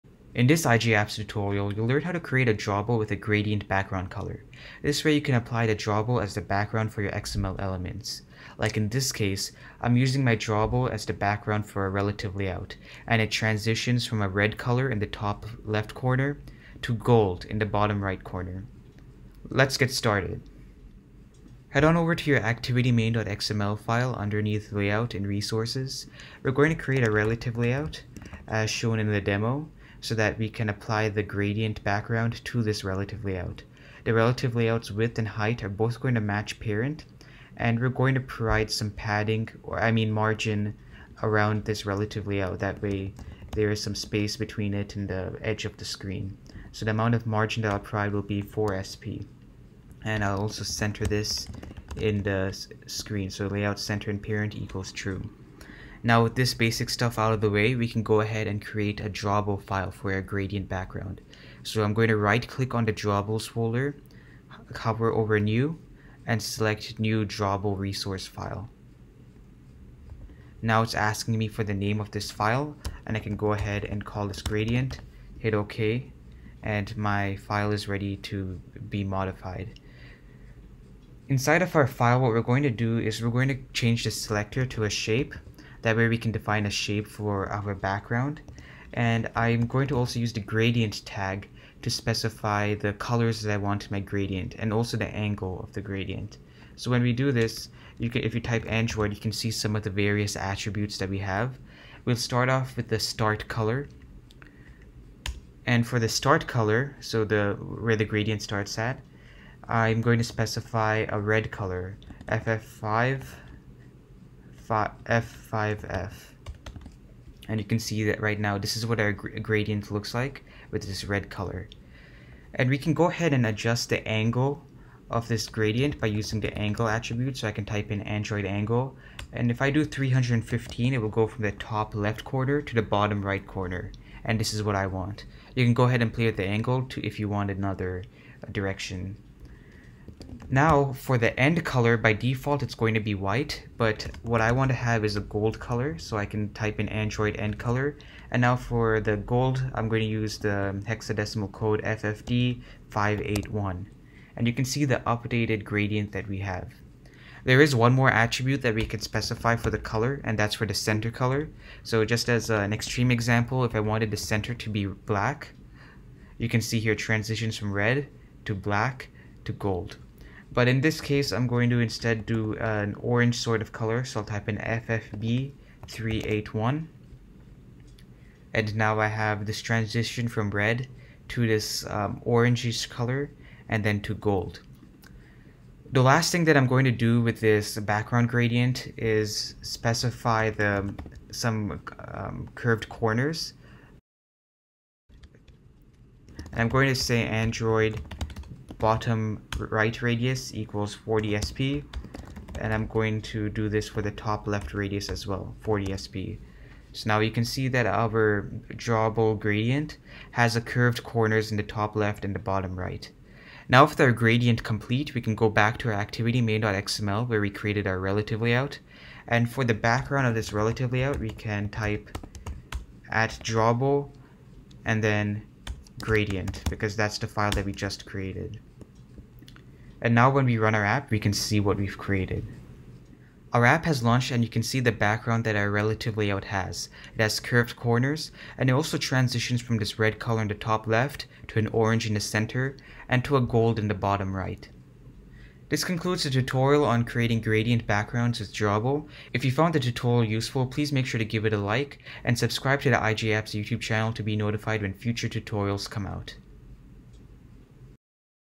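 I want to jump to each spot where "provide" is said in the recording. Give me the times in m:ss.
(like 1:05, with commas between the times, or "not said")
0:38, 0:47.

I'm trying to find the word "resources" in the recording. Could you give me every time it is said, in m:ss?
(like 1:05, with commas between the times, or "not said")
0:25, 1:07.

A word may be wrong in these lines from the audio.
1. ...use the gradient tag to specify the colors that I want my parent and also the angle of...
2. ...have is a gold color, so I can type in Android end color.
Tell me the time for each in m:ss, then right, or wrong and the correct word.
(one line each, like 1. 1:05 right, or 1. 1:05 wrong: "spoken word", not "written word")
1. 1:30 wrong: "gradient", not "parent"
2. 2:24 right.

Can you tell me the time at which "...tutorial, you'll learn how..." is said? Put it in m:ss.
0:01.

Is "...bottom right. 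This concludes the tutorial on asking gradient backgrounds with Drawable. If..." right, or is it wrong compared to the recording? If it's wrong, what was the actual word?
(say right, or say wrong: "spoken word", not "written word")
wrong: "creating", not "asking".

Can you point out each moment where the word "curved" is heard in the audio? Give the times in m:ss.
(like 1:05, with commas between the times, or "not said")
3:12, 3:30, 3:57.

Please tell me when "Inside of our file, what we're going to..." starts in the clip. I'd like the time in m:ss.
1:21.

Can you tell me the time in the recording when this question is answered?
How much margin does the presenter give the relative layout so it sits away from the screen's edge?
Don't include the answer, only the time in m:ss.
0:48.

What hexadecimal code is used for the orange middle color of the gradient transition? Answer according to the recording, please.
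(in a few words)
FFB381.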